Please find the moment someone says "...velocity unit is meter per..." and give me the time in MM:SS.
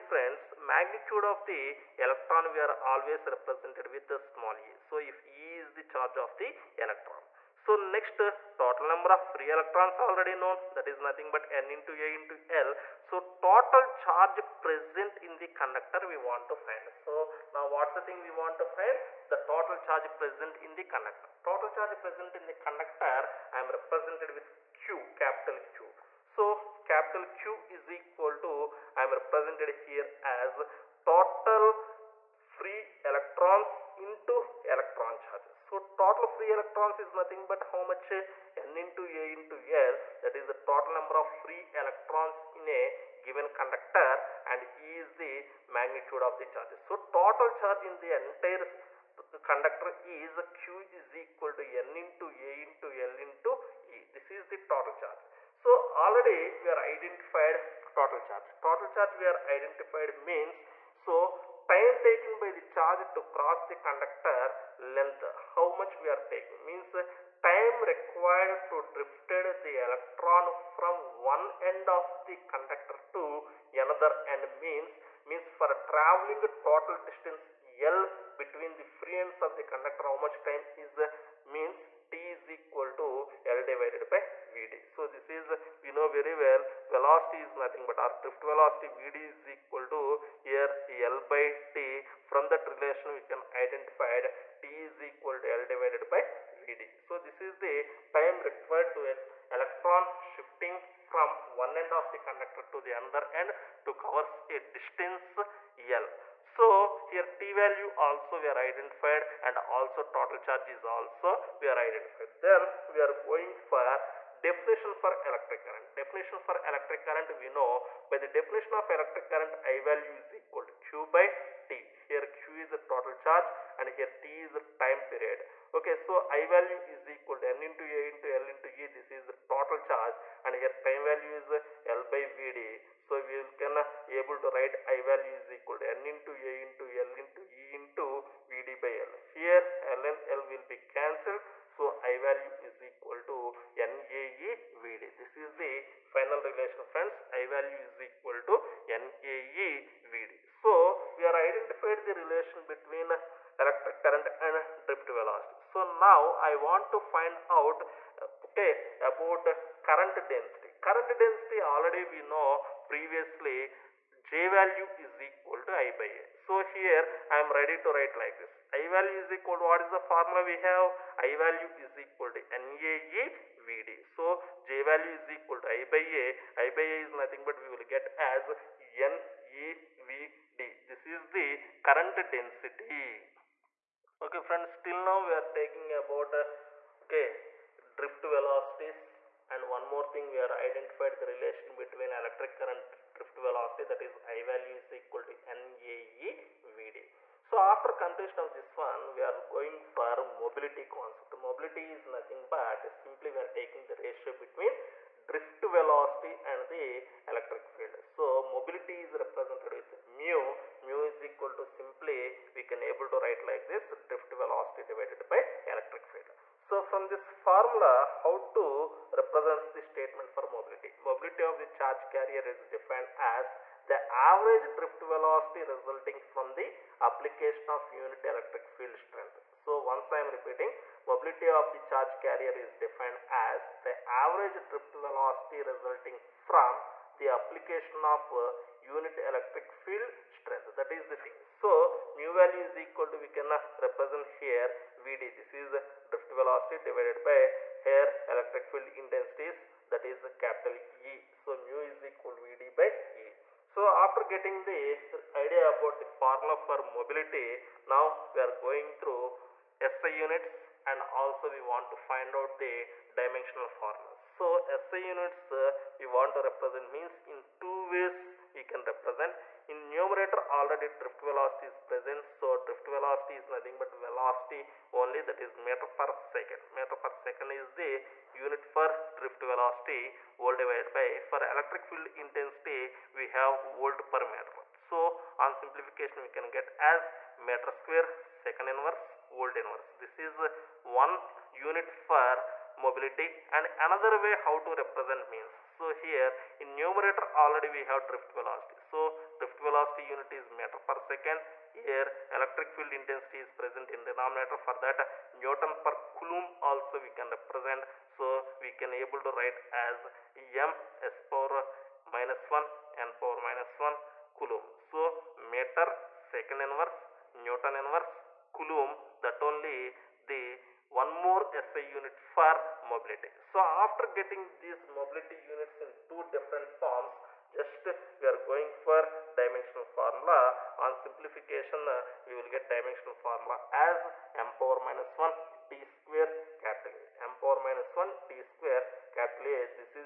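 04:59.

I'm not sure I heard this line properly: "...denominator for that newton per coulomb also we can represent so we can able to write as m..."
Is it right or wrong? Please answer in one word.
right.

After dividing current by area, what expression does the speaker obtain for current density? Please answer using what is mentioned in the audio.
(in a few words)
neVd.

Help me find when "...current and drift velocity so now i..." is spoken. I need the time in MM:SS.
02:34.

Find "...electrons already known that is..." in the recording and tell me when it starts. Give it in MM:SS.
00:09.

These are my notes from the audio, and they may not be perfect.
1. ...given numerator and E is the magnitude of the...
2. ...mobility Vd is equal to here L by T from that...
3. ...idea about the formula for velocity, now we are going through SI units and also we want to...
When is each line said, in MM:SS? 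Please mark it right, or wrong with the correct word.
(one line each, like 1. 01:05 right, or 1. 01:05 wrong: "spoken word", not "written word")
1. 00:43 wrong: "conductor", not "numerator"
2. 01:28 wrong: "velocity", not "mobility"
3. 04:15 wrong: "mobility", not "velocity".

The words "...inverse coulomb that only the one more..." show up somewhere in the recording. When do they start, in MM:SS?
05:17.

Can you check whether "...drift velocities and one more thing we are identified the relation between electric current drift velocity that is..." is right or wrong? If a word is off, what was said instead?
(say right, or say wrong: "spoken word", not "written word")
right.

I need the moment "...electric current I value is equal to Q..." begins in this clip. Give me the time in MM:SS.
01:58.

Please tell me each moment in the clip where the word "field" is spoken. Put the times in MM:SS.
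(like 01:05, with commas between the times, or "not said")
03:27, 03:36, 03:48, 03:59, 04:08, 04:41, 05:02.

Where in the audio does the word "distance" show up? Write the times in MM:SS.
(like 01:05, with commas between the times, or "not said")
01:17, 01:44.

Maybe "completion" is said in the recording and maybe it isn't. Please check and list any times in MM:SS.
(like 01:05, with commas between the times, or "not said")
03:18.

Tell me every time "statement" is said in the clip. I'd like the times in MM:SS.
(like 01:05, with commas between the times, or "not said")
03:39.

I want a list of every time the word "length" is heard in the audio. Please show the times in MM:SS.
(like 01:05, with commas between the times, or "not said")
01:04.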